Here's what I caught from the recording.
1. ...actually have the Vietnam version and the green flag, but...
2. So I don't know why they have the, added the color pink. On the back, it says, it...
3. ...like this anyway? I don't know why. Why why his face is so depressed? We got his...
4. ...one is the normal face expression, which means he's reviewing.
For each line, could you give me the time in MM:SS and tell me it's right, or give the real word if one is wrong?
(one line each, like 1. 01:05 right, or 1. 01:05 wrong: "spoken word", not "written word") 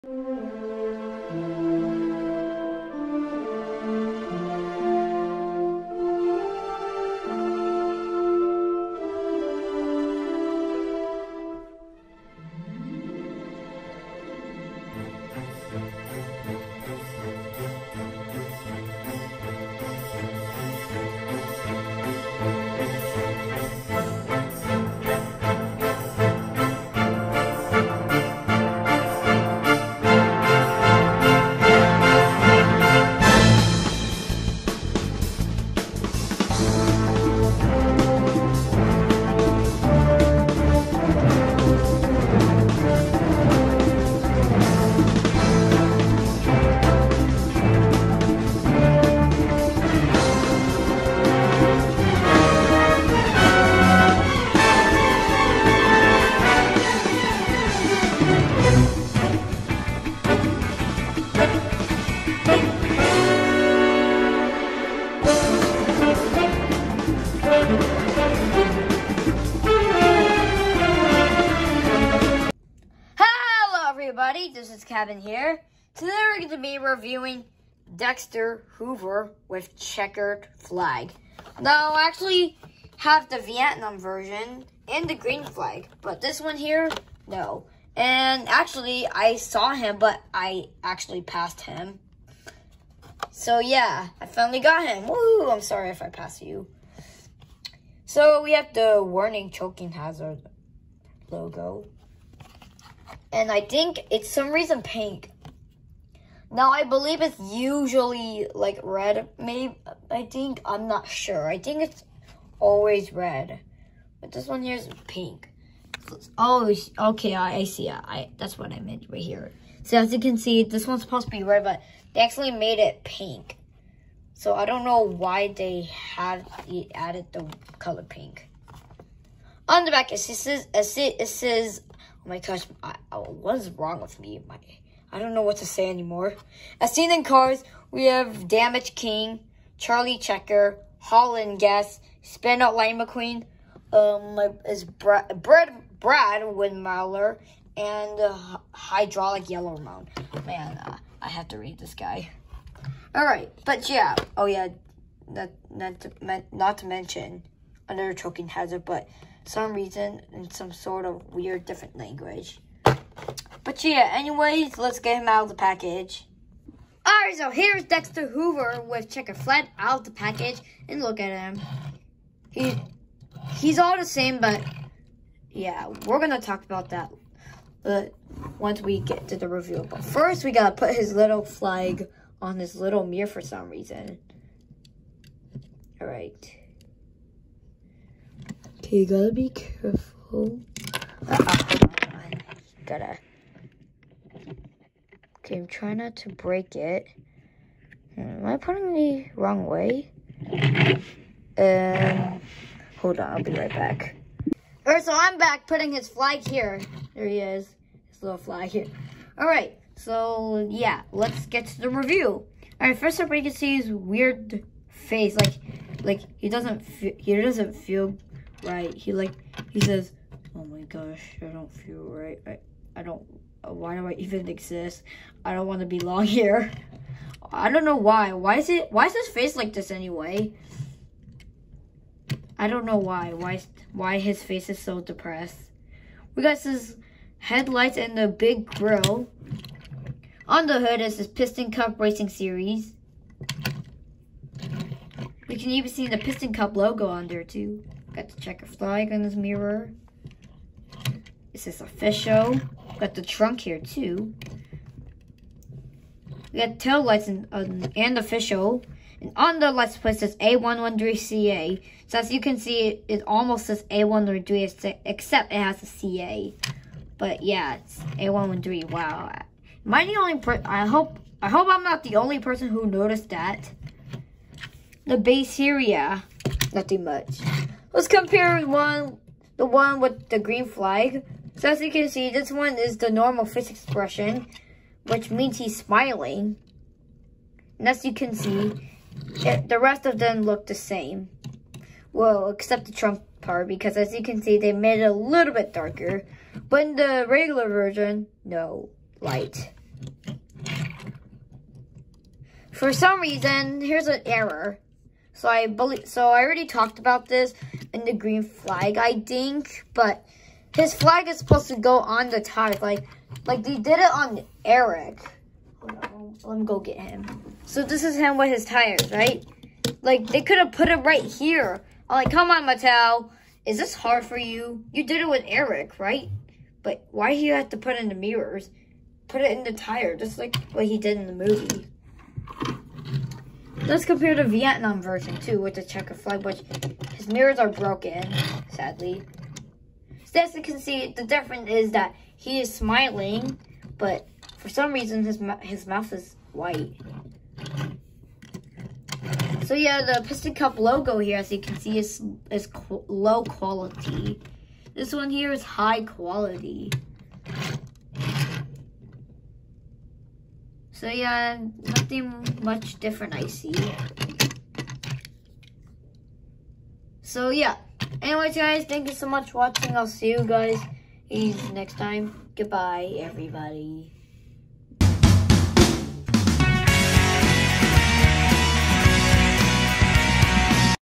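1. 01:22 right
2. 02:04 right
3. 03:49 right
4. 04:42 wrong: "smiling", not "reviewing".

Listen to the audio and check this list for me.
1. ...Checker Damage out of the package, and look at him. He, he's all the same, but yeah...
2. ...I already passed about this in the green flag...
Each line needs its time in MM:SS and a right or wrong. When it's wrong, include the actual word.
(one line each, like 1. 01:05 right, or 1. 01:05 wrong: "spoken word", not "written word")
1. 02:49 wrong: "Flag", not "Damage"
2. 05:06 wrong: "talked", not "passed".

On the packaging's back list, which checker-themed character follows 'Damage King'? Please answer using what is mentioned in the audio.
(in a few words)
Charlie Checker.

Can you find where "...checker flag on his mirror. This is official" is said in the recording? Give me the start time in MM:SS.
04:08.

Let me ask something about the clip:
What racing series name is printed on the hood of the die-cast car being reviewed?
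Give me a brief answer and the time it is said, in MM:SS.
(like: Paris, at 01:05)
Piston Cup Racing Series, at 04:01.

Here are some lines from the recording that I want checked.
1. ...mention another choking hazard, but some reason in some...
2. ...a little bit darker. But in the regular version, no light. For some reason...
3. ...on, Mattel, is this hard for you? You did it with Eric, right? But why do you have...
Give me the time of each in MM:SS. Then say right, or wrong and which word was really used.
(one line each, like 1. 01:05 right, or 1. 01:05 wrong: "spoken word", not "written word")
1. 02:36 right
2. 04:55 right
3. 05:22 right.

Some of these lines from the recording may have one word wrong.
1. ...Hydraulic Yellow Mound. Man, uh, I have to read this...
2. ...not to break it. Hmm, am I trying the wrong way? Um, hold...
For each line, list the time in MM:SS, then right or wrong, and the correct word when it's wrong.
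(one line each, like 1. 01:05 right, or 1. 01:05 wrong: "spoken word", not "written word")
1. 02:28 right
2. 03:16 wrong: "putting", not "trying".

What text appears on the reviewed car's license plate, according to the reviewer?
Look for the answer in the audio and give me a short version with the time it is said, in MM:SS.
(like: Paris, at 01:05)
A113CA, at 04:20.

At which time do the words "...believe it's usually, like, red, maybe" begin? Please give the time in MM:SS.
01:46.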